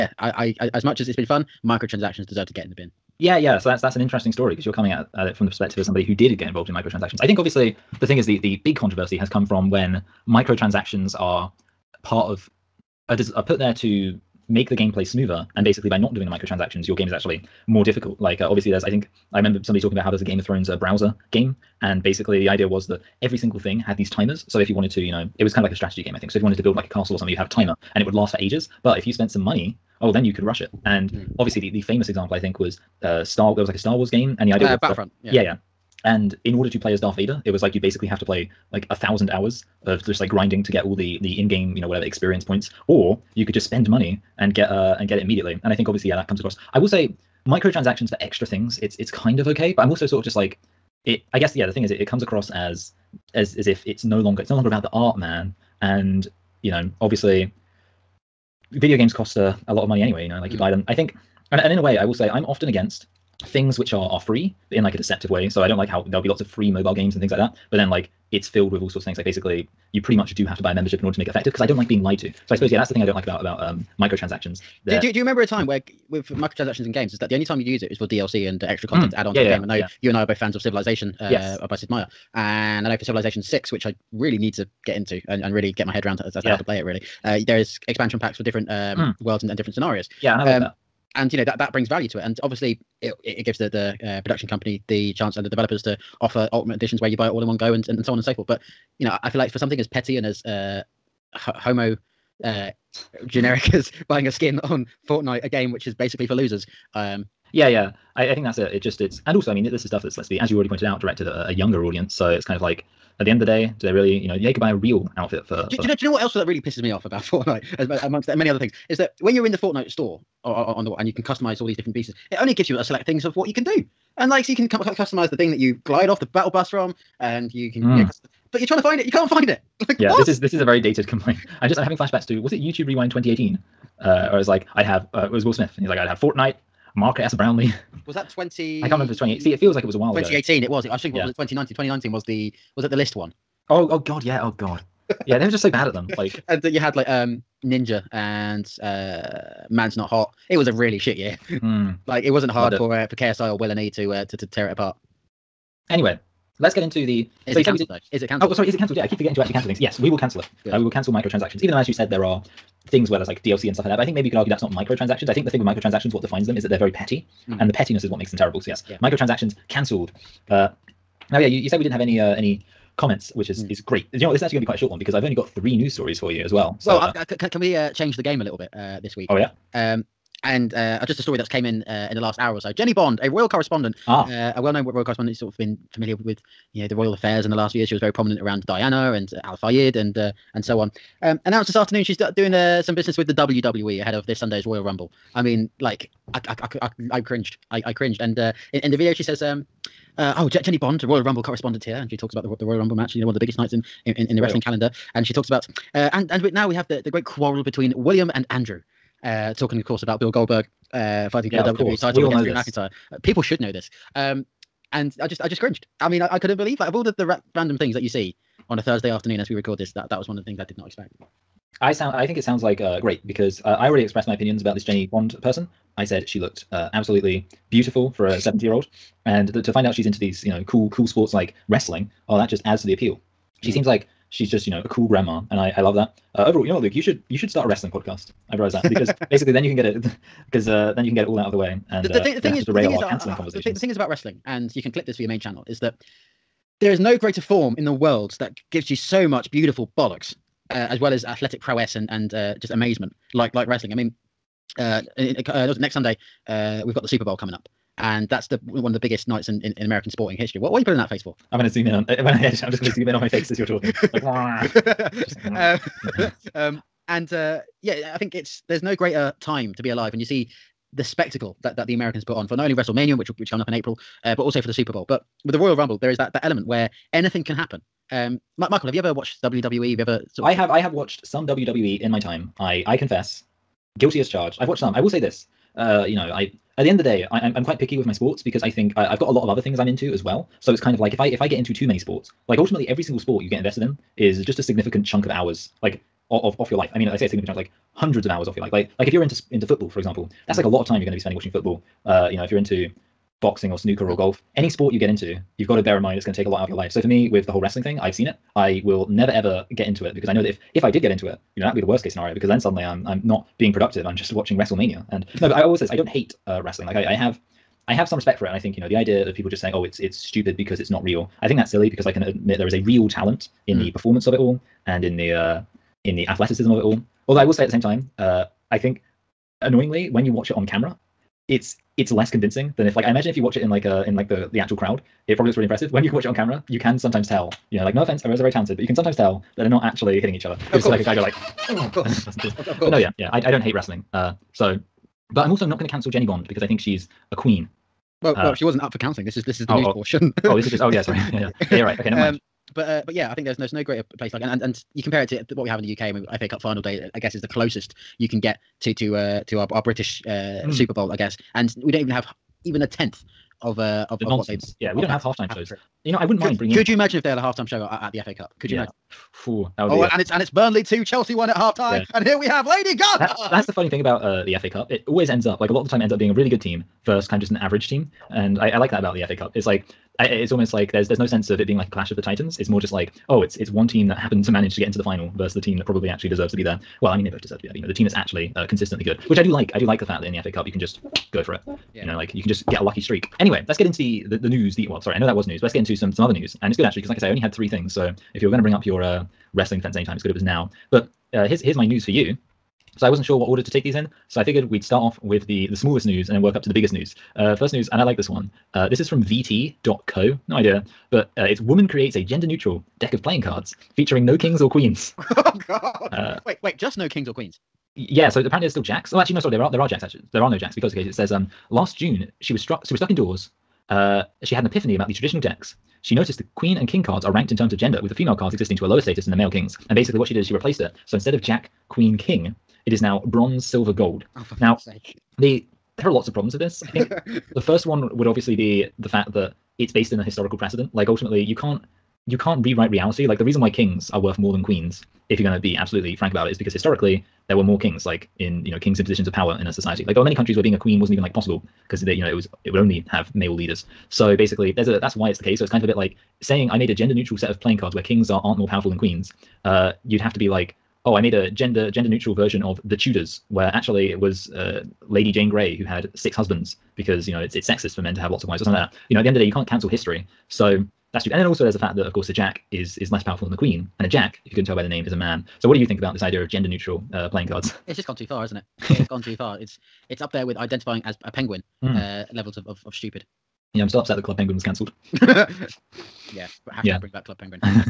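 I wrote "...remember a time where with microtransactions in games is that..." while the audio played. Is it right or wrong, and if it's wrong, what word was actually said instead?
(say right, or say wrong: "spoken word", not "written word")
right.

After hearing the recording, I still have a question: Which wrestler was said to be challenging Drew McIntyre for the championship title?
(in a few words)
Bill Goldberg.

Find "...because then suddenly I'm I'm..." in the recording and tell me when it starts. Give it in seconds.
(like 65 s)
312 s.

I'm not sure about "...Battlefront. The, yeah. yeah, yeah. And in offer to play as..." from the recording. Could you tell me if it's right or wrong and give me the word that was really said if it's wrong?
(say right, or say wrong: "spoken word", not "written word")
wrong: "order", not "offer".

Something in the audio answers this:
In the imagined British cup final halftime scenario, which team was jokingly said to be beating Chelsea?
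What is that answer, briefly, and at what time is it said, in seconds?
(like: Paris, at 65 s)
Burnley, at 370 s.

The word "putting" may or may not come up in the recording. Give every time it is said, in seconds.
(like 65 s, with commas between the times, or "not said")
260 s.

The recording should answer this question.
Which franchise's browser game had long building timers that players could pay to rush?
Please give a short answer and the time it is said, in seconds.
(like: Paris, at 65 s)
Game of Thrones, at 20 s.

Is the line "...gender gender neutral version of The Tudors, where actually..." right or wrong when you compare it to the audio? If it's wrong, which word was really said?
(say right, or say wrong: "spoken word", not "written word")
right.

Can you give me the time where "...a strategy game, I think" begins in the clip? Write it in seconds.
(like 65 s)
25 s.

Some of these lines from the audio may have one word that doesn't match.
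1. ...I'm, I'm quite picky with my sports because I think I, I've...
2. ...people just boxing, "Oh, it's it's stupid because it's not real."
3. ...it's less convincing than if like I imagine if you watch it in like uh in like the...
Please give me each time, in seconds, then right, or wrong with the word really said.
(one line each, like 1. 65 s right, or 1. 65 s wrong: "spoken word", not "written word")
1. 287 s right
2. 319 s wrong: "saying", not "boxing"
3. 331 s right.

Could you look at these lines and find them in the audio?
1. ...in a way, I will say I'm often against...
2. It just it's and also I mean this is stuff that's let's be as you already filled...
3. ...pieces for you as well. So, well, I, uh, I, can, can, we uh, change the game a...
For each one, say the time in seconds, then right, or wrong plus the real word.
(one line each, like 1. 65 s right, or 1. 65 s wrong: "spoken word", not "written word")
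1. 61 s right
2. 108 s wrong: "pointed", not "filled"
3. 175 s wrong: "stories", not "pieces".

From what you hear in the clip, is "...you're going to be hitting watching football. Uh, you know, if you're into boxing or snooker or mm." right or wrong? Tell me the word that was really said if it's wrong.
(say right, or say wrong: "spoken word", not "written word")
wrong: "spending", not "hitting".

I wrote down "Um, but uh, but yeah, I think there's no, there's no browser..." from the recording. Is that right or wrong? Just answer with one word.
wrong.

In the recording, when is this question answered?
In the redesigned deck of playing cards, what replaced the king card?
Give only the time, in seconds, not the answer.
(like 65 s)
433 s.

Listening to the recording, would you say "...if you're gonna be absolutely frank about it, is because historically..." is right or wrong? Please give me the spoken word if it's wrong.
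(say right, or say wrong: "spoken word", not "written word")
right.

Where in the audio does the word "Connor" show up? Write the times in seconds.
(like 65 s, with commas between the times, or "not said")
not said.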